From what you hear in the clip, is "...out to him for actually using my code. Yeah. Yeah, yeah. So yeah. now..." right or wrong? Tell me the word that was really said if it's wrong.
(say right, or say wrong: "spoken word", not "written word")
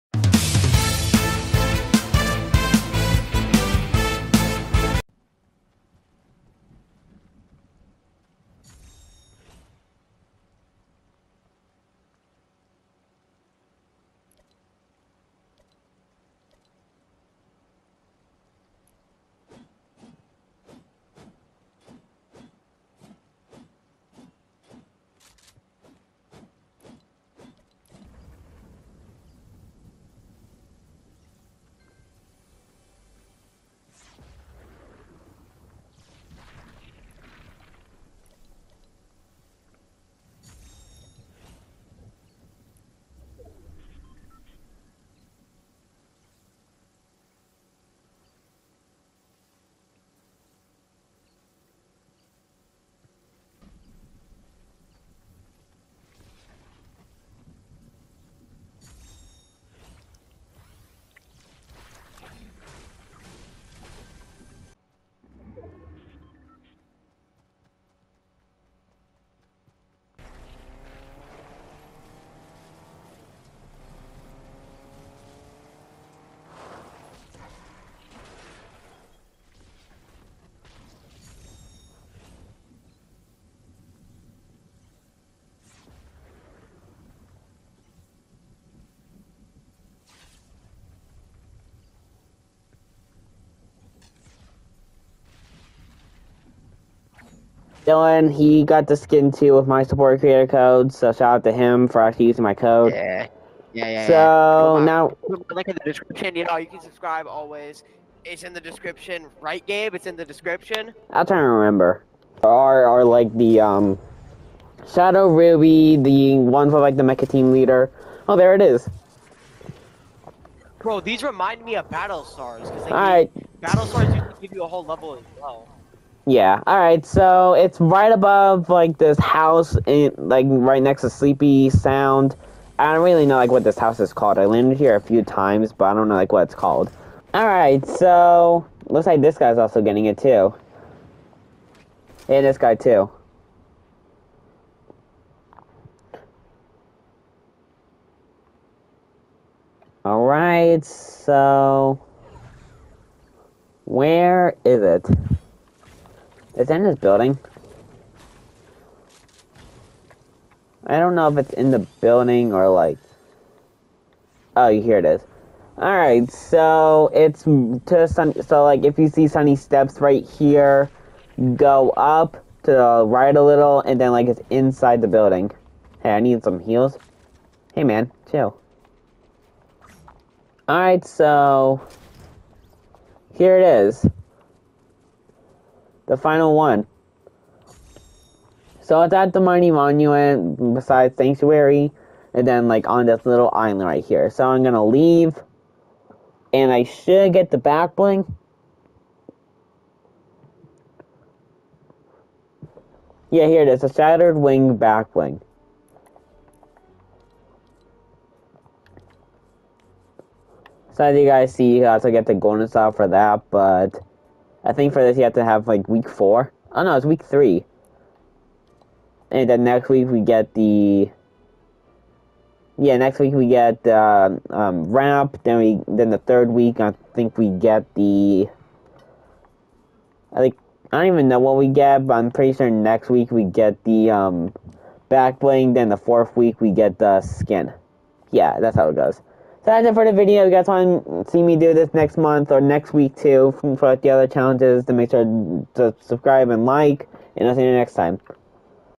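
right.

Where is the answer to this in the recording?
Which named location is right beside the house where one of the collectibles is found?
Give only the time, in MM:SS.
02:11.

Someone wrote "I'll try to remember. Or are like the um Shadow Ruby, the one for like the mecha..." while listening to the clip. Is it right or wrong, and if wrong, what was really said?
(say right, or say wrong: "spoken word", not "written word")
right.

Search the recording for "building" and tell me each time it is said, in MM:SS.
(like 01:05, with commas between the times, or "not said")
02:36, 02:42, 02:55.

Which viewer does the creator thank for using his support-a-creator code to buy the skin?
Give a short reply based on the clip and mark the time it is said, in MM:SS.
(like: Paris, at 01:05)
Dylan, at 01:37.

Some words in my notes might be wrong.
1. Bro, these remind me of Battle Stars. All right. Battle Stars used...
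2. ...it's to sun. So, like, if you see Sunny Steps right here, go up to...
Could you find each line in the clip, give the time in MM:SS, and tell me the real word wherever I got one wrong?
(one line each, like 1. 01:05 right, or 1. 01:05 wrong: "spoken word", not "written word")
1. 02:00 right
2. 02:47 right.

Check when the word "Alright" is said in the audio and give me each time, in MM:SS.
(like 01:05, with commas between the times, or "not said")
02:45, 03:00.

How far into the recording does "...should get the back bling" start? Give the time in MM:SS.
03:16.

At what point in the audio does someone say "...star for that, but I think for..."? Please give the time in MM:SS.
03:32.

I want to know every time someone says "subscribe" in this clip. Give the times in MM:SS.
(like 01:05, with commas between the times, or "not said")
01:46, 04:06.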